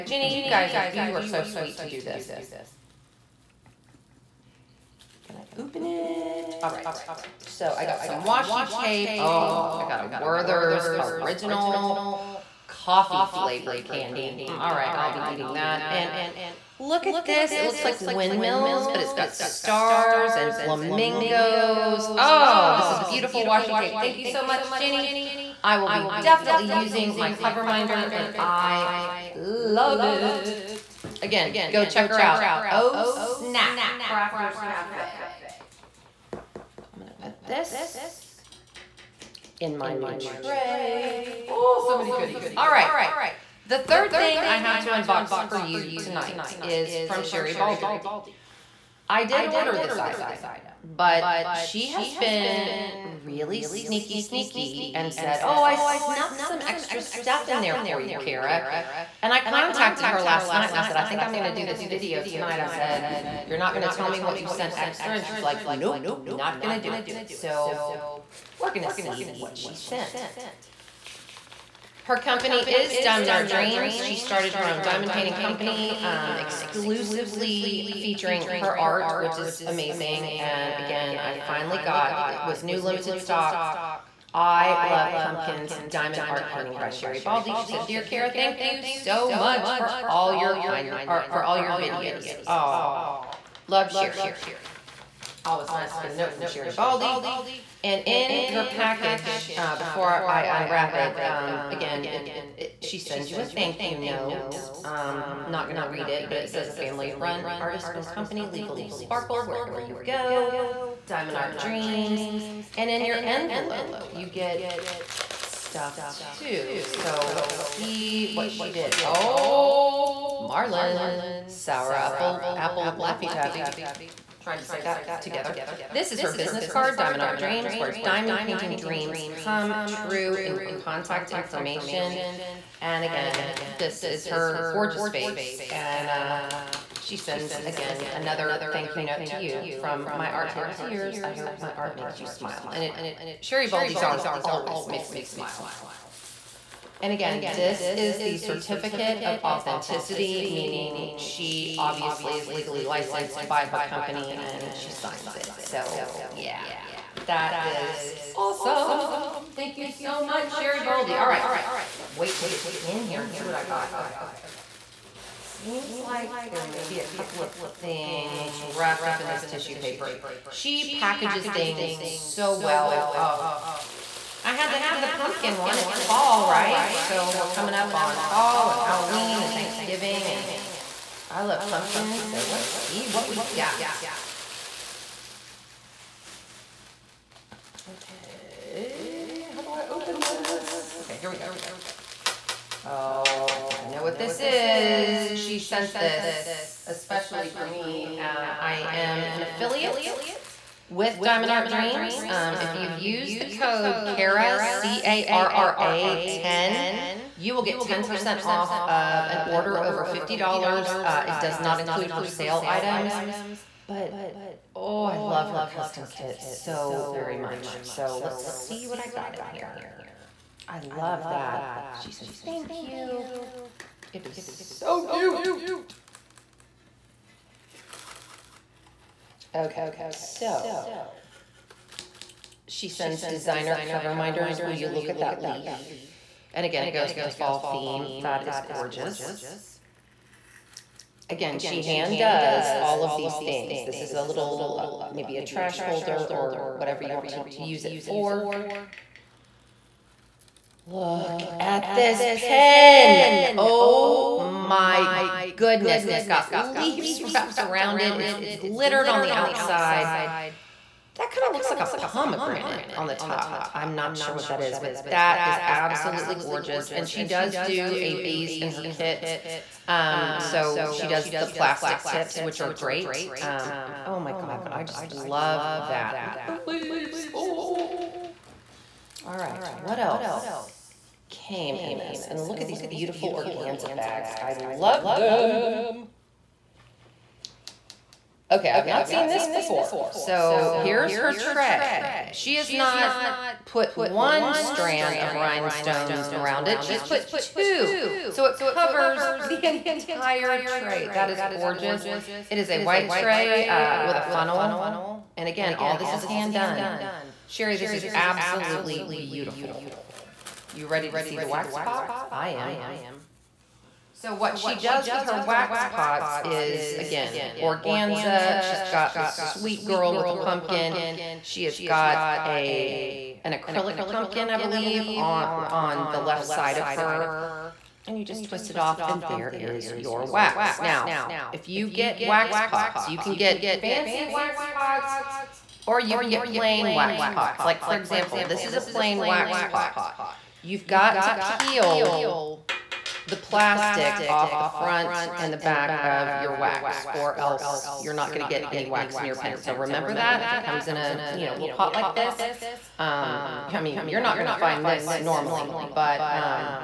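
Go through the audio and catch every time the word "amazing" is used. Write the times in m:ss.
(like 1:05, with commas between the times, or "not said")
1:19.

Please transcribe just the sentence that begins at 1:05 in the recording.
And she's like, Nope, not going to do it.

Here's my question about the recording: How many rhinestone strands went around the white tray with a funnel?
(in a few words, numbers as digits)
2.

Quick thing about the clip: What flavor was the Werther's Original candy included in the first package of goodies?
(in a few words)
Coffee.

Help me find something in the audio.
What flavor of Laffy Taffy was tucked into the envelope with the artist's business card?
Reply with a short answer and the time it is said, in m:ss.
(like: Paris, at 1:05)
Sour apple, at 2:01.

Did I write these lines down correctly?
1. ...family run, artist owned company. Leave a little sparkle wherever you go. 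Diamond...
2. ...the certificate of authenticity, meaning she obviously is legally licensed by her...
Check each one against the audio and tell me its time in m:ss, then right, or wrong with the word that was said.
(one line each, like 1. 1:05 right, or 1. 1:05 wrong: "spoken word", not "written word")
1. 1:46 right
2. 2:28 right.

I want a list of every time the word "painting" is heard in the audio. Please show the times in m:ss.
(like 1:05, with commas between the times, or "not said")
1:15, 1:26, 2:08.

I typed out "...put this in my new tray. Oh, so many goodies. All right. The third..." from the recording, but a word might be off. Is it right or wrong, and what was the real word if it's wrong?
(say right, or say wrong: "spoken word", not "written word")
right.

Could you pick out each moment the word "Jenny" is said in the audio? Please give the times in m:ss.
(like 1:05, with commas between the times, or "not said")
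0:00, 0:24.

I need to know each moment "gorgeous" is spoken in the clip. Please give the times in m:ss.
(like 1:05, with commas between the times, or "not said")
2:14, 3:58, 4:26, 5:01.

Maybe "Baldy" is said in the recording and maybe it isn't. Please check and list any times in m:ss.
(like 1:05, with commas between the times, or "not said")
0:47, 1:27, 1:36, 2:23, 2:40.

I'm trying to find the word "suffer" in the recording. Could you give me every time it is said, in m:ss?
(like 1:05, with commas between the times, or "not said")
not said.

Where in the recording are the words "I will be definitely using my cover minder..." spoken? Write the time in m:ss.
0:25.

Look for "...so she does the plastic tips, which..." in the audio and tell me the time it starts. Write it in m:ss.
4:30.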